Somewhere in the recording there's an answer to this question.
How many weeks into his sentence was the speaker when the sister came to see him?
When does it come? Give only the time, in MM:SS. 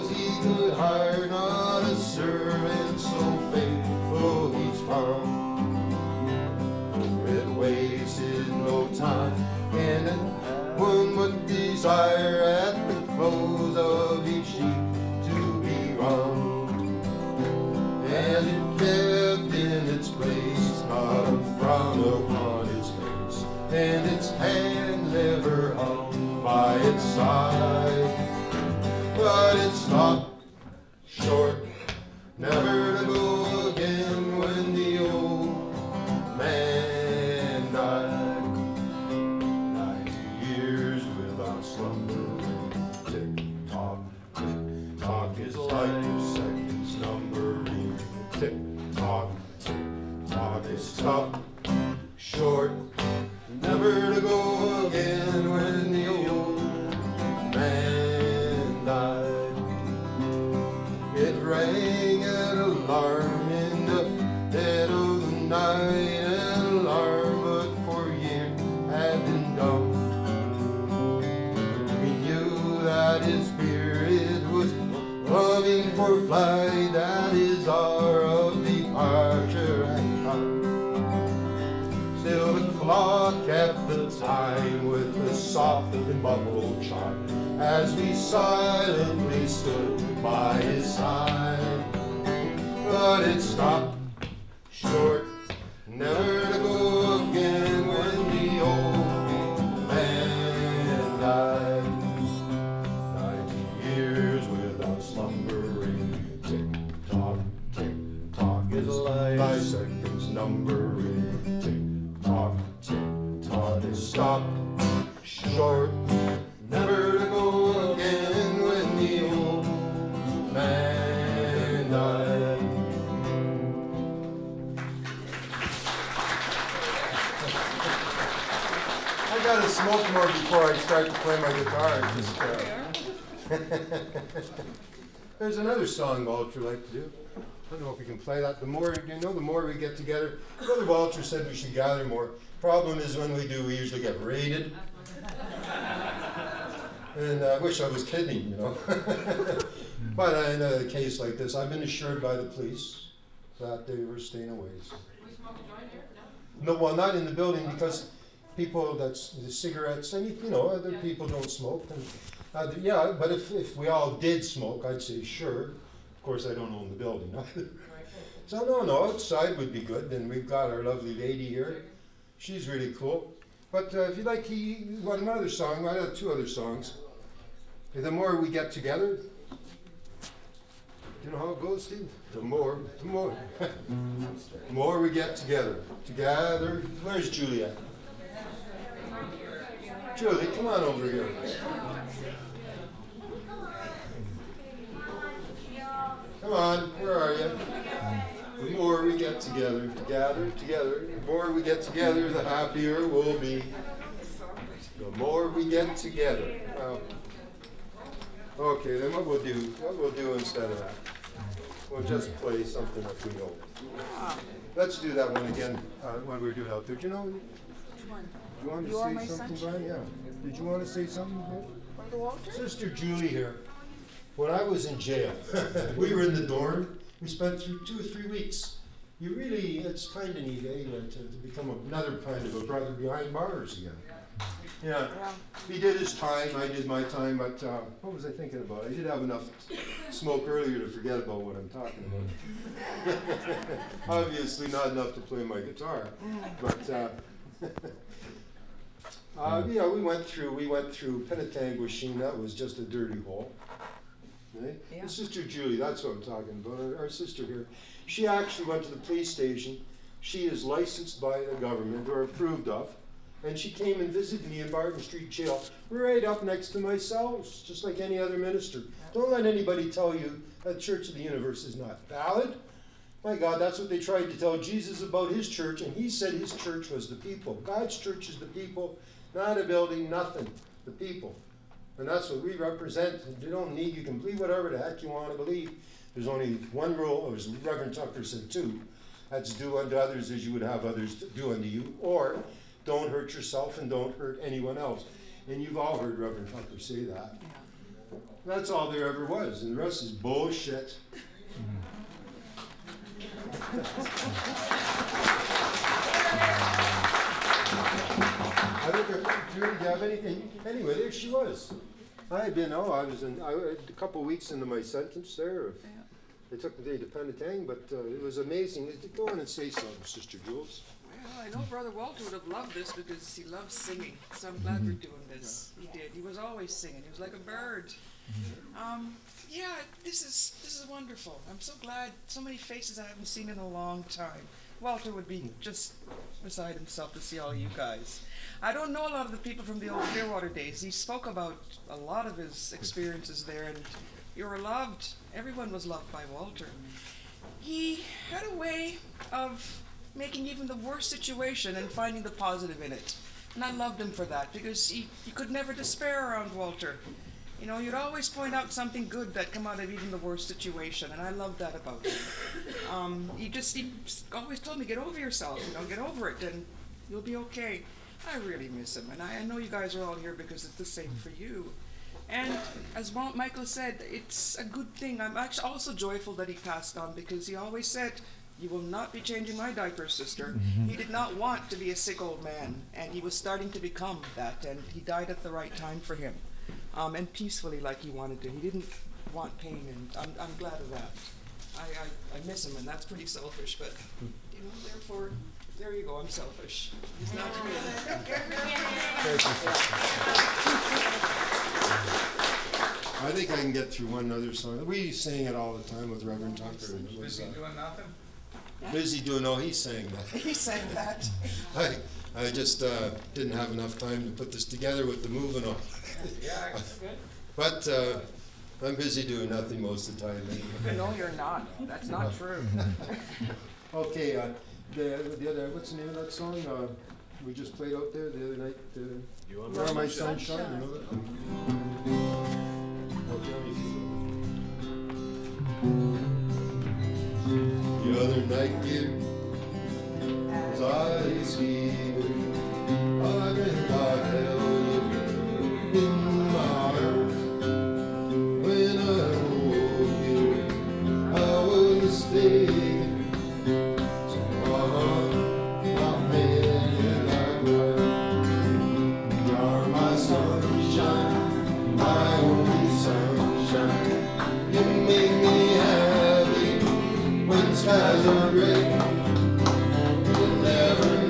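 05:13.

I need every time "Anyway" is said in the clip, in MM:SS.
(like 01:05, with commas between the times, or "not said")
05:10, 07:00.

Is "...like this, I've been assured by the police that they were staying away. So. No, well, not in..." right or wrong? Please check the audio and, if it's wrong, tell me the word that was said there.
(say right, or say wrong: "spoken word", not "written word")
right.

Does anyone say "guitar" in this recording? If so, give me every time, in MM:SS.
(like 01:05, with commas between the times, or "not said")
02:11, 04:05.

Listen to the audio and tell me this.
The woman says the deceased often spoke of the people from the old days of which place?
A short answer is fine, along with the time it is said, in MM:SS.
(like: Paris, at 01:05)
Clearwater, at 05:40.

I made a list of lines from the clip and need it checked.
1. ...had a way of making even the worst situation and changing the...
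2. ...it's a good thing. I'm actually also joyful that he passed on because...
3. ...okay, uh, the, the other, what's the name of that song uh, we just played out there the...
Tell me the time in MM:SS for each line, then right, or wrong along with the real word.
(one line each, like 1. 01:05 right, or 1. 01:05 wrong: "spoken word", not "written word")
1. 05:48 wrong: "finding", not "changing"
2. 06:14 right
3. 07:03 right.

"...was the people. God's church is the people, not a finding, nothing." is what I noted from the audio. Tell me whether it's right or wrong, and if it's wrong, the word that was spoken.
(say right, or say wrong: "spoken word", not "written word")
wrong: "building", not "finding".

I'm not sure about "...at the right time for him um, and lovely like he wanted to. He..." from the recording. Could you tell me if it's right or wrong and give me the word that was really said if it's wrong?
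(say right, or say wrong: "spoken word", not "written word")
wrong: "peacefully", not "lovely".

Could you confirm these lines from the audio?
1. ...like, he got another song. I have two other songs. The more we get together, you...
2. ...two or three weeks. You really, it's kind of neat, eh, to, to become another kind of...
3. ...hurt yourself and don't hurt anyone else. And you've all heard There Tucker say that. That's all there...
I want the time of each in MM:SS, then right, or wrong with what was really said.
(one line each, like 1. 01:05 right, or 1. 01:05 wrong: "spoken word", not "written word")
1. 02:54 right
2. 03:47 right
3. 04:53 wrong: "Reverend", not "There".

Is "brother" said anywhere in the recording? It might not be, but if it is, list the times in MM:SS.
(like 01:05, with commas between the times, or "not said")
02:20, 03:41, 03:52, 05:21.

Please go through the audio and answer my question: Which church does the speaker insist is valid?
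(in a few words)
Church of the Universe.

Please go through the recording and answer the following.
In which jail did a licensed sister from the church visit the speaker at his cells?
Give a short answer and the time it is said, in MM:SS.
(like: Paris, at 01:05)
Barton Street Jail, at 04:24.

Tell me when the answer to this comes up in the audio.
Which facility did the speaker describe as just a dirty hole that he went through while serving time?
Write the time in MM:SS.
04:11.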